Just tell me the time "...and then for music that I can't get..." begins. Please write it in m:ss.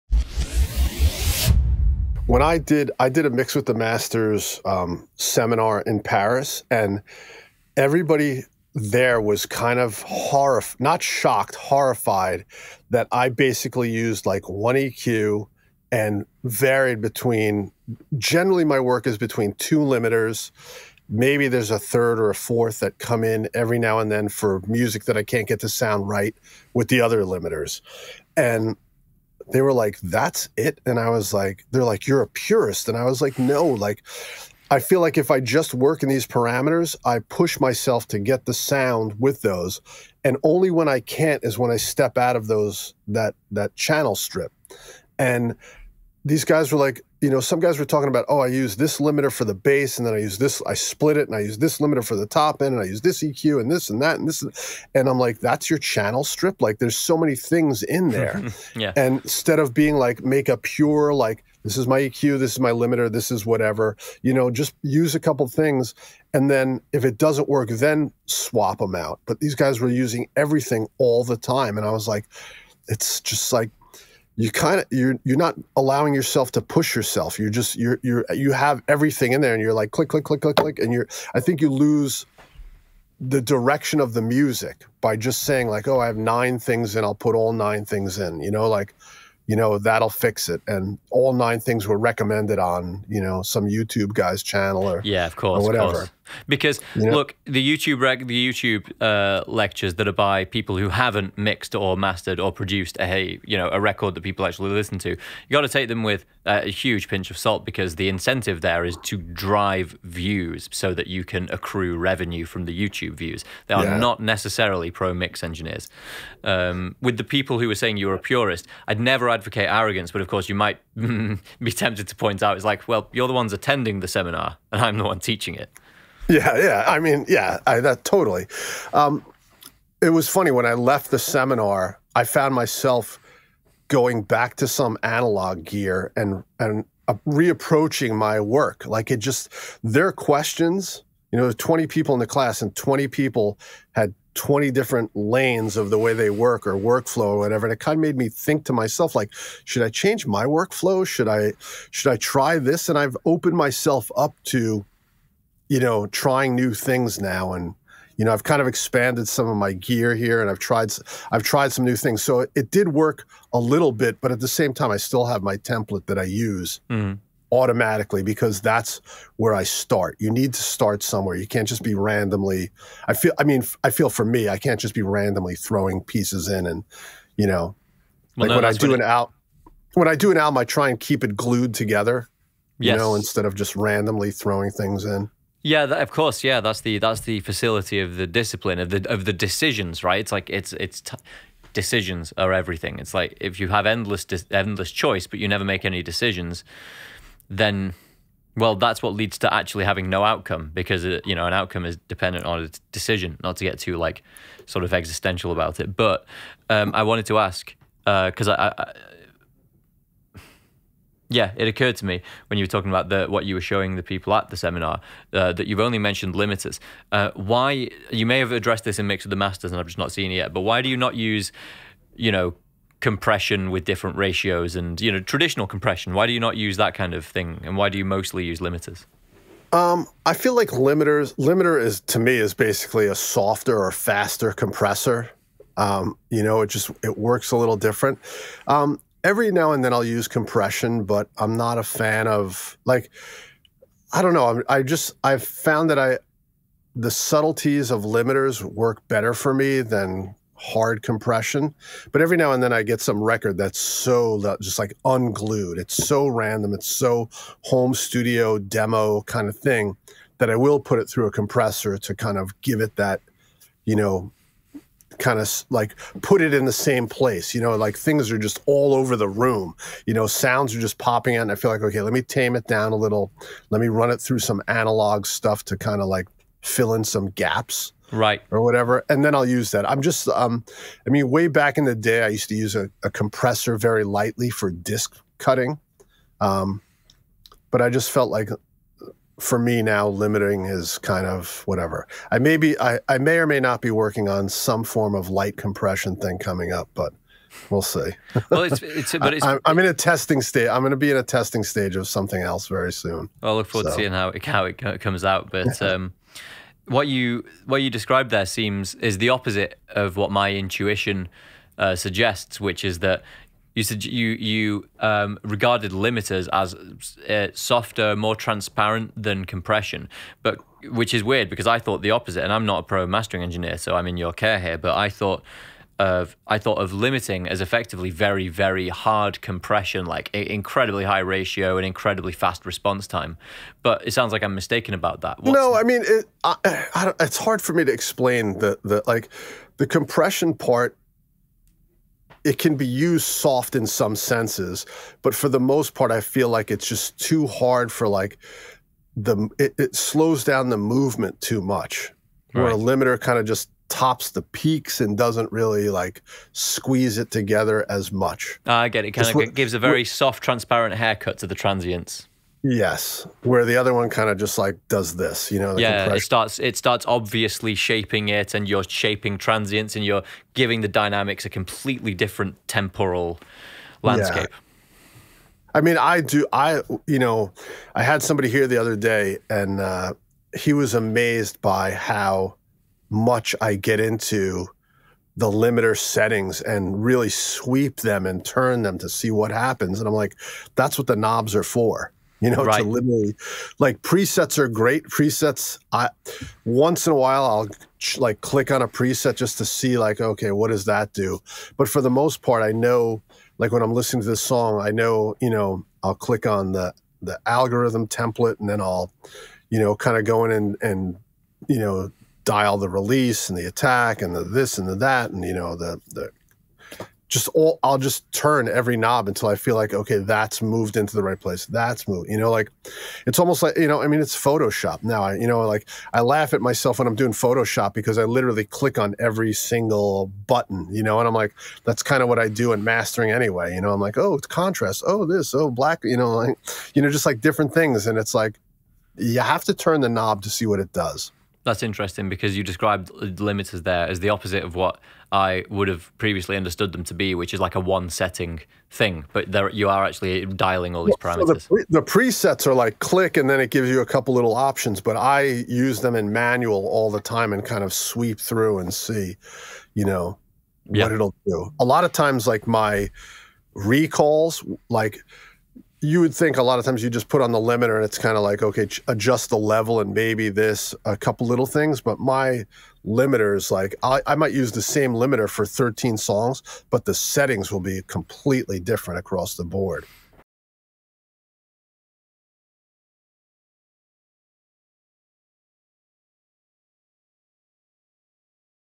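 0:23.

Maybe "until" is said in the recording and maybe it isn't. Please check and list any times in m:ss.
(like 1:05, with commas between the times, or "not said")
6:59.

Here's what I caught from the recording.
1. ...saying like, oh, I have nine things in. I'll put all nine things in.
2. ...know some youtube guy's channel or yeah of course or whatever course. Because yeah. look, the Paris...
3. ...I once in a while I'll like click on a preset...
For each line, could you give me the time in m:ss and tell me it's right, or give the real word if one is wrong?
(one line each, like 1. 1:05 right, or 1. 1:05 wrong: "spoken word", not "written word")
1. 1:25 right
2. 1:33 wrong: "YouTube", not "Paris"
3. 6:35 right.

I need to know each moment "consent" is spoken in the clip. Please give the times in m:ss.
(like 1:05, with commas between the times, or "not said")
not said.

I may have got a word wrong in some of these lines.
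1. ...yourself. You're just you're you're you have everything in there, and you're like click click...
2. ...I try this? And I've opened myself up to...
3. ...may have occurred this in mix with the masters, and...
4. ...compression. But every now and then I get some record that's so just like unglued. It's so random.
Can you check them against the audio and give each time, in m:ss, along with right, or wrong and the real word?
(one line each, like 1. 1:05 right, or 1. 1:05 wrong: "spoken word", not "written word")
1. 1:16 right
2. 2:32 right
3. 3:38 wrong: "addressed", not "occurred"
4. 4:11 right.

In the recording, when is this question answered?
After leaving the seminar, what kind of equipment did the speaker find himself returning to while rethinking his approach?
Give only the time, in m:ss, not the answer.
2:15.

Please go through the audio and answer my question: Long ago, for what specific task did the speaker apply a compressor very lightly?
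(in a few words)
Disc cutting.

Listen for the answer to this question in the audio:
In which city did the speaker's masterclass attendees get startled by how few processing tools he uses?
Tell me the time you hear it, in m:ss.
0:06.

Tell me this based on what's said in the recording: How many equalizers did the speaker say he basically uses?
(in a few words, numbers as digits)
1.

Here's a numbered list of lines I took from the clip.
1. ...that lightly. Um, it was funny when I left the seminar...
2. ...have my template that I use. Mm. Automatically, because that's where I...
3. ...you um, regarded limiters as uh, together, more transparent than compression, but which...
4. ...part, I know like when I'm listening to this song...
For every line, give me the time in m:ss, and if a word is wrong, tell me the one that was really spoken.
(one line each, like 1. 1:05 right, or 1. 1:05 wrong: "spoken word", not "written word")
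1. 2:07 wrong: "totally", not "lightly"
2. 2:45 right
3. 5:14 wrong: "softer", not "together"
4. 6:42 right.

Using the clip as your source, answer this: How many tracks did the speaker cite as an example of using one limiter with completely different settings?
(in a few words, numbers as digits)
13.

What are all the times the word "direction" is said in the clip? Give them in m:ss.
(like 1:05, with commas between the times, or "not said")
1:23.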